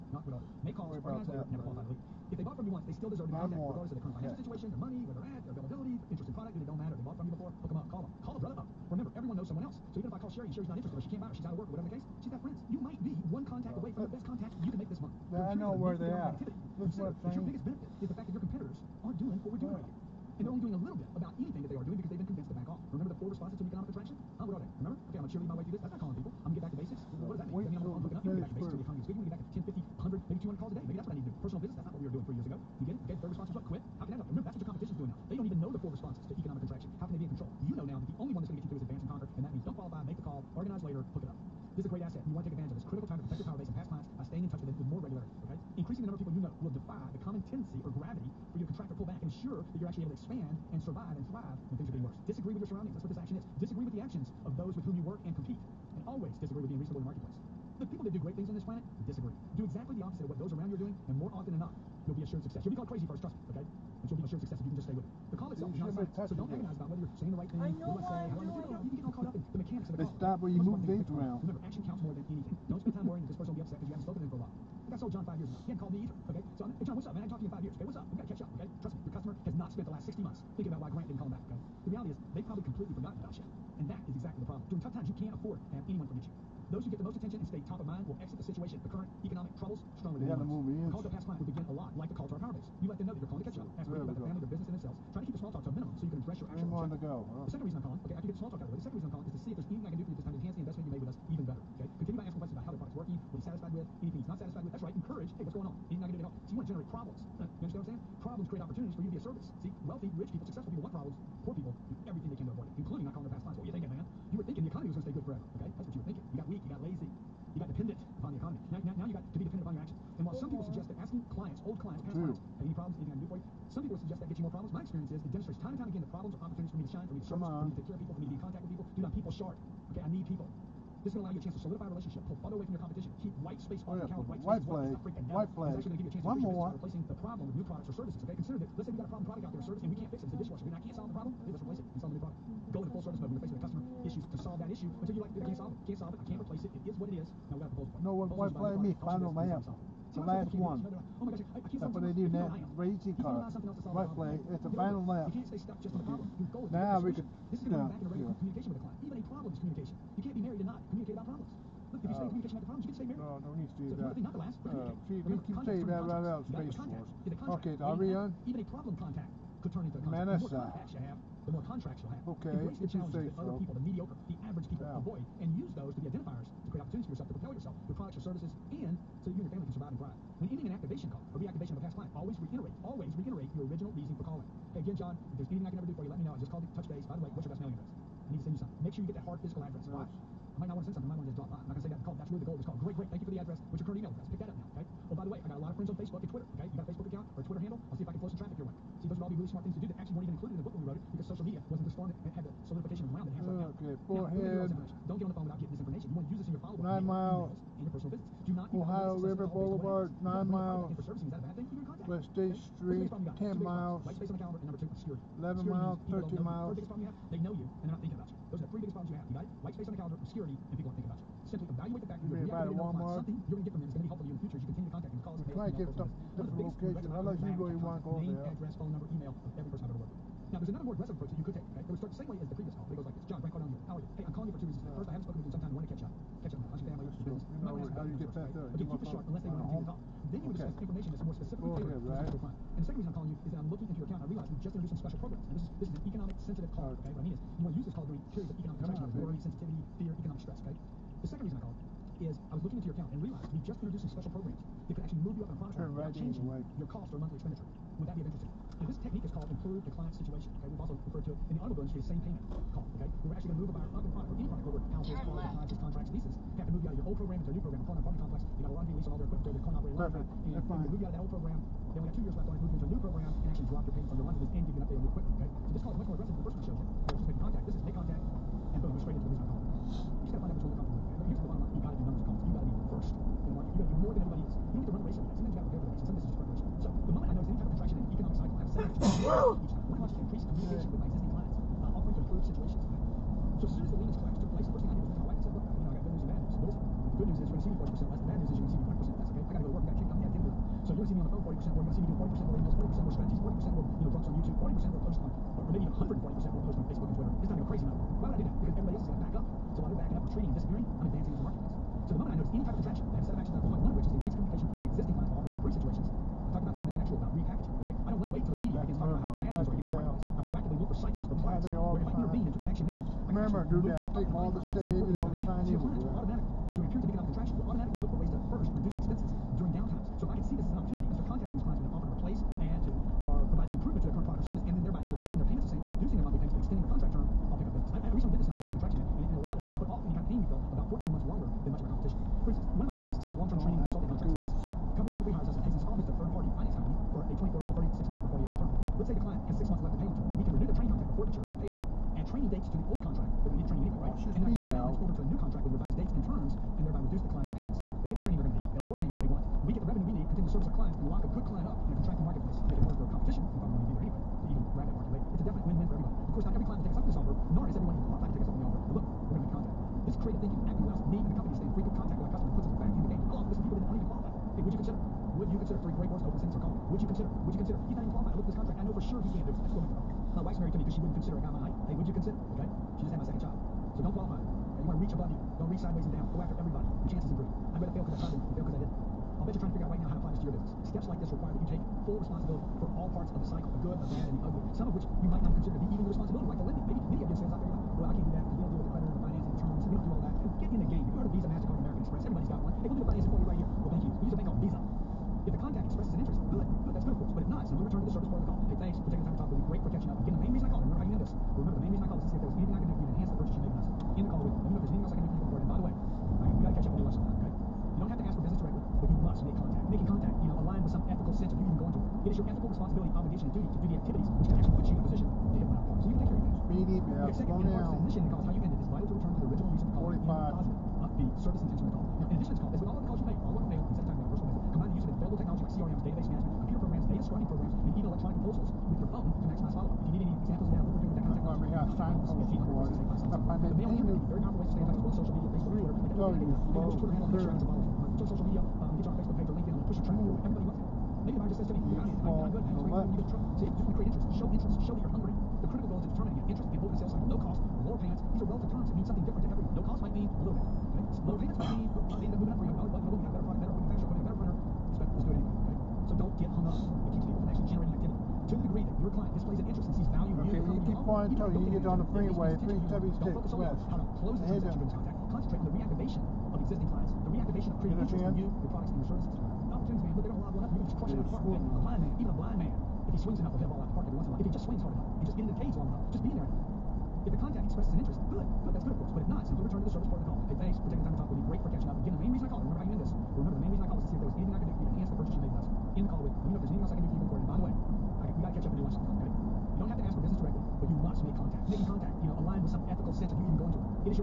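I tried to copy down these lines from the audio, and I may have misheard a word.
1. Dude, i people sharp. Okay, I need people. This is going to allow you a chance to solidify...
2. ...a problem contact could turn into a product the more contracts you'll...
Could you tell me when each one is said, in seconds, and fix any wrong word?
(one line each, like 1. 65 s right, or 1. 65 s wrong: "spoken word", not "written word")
1. 128 s right
2. 168 s wrong: "contact", not "product".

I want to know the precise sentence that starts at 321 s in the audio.
Where am I intervening into action now?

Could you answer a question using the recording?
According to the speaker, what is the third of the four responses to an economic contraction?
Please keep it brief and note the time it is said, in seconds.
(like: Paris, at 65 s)
Quit, at 33 s.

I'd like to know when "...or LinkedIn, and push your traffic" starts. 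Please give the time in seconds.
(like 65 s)
449 s.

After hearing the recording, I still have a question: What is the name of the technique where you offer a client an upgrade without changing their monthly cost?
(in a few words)
Improve the client situation.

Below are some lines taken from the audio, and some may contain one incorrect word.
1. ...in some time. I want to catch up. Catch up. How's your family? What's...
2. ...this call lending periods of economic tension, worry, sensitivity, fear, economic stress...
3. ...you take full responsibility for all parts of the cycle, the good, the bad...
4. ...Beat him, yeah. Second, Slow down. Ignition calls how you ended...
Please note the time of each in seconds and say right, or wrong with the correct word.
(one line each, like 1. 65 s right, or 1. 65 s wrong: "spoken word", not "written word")
1. 235 s right
2. 247 s wrong: "during", not "lending"
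3. 391 s right
4. 426 s right.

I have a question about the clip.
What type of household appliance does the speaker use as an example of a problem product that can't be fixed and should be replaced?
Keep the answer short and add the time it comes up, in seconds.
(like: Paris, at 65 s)
Dishwasher, at 140 s.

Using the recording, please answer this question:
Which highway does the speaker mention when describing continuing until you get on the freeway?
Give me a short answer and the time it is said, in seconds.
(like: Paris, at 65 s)
Three W six west, at 472 s.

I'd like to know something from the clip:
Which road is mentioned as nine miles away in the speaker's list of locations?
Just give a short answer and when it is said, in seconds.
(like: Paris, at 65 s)
Ohio River Boulevard, at 208 s.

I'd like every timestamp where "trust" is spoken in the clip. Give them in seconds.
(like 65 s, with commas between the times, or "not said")
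63 s.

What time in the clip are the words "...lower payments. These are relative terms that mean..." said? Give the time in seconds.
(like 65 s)
457 s.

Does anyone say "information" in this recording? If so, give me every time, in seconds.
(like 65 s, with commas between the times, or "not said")
205 s, 240 s.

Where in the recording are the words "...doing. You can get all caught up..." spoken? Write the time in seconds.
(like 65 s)
68 s.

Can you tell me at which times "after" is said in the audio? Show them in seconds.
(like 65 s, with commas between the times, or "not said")
98 s, 386 s.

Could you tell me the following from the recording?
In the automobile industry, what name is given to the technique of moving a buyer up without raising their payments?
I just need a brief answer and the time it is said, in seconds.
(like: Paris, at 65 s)
Same payment call, at 262 s.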